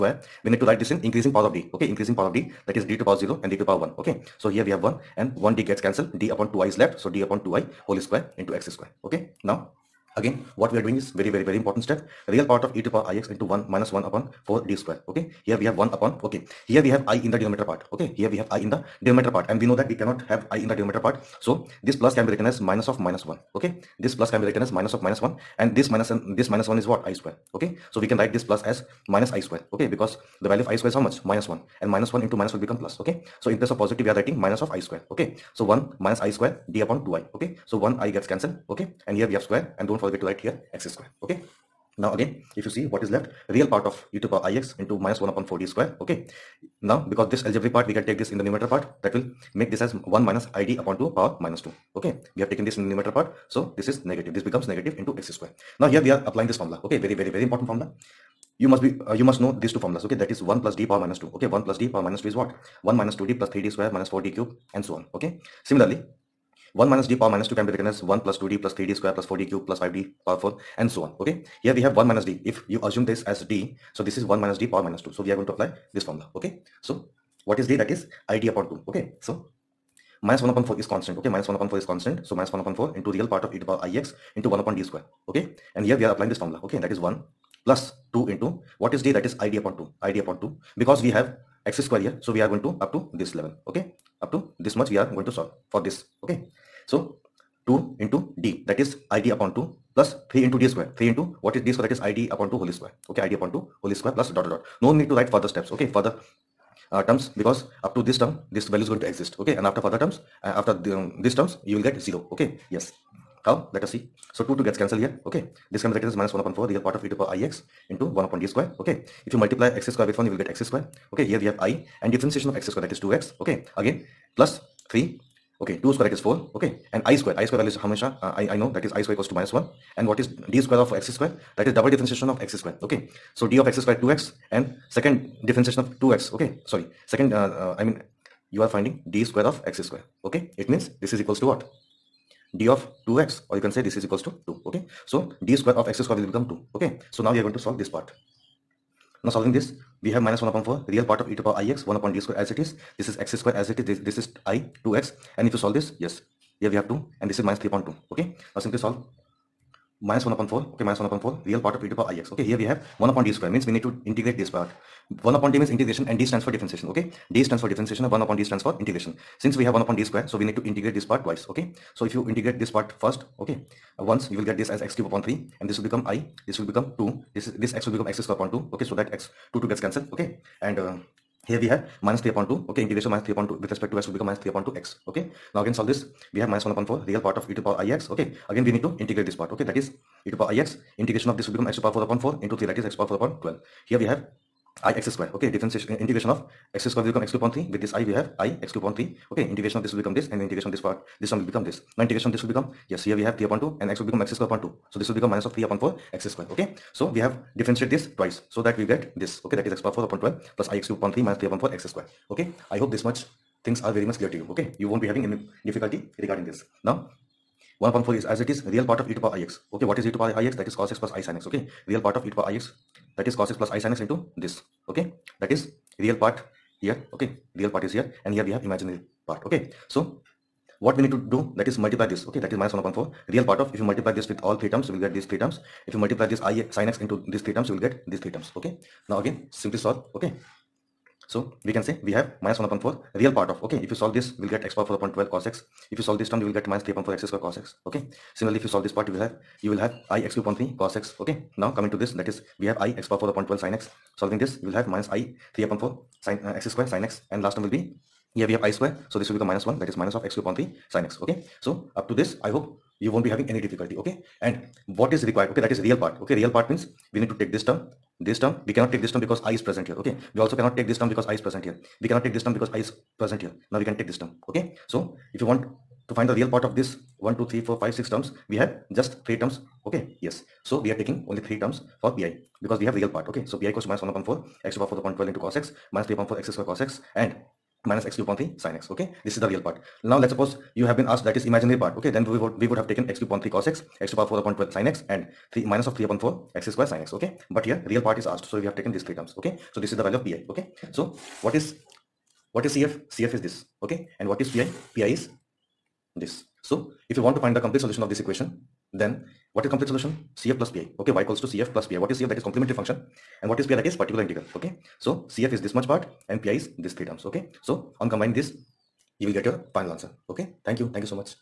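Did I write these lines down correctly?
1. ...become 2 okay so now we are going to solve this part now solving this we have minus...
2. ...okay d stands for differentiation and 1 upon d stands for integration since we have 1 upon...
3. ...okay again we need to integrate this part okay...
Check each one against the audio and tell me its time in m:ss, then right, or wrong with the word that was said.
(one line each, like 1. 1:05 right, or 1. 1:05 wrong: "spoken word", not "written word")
1. 2:26 right
2. 2:46 right
3. 3:08 right.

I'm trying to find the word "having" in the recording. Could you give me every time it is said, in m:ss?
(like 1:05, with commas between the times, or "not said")
3:35, 4:23.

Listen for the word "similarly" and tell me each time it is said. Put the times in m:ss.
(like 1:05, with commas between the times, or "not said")
1:05, 4:08.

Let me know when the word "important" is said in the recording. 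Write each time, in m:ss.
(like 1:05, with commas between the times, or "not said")
0:11, 0:57.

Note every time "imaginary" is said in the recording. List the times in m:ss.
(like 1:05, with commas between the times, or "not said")
3:48, 4:51.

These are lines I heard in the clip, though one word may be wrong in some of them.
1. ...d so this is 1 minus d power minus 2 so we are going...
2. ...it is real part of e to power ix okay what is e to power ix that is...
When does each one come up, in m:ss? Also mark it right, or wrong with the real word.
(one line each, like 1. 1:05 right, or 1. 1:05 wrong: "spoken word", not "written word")
1. 1:13 right
2. 3:38 right.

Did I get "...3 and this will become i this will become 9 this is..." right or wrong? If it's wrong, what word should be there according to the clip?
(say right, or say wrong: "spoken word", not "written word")
wrong: "2", not "9".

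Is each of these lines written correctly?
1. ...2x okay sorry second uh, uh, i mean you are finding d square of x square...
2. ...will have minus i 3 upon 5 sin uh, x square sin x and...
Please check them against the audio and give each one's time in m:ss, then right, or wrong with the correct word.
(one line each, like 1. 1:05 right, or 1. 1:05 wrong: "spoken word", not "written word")
1. 2:16 right
2. 4:14 wrong: "4", not "5".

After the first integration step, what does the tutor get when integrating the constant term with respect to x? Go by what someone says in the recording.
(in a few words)
minus 3 upon 2 x.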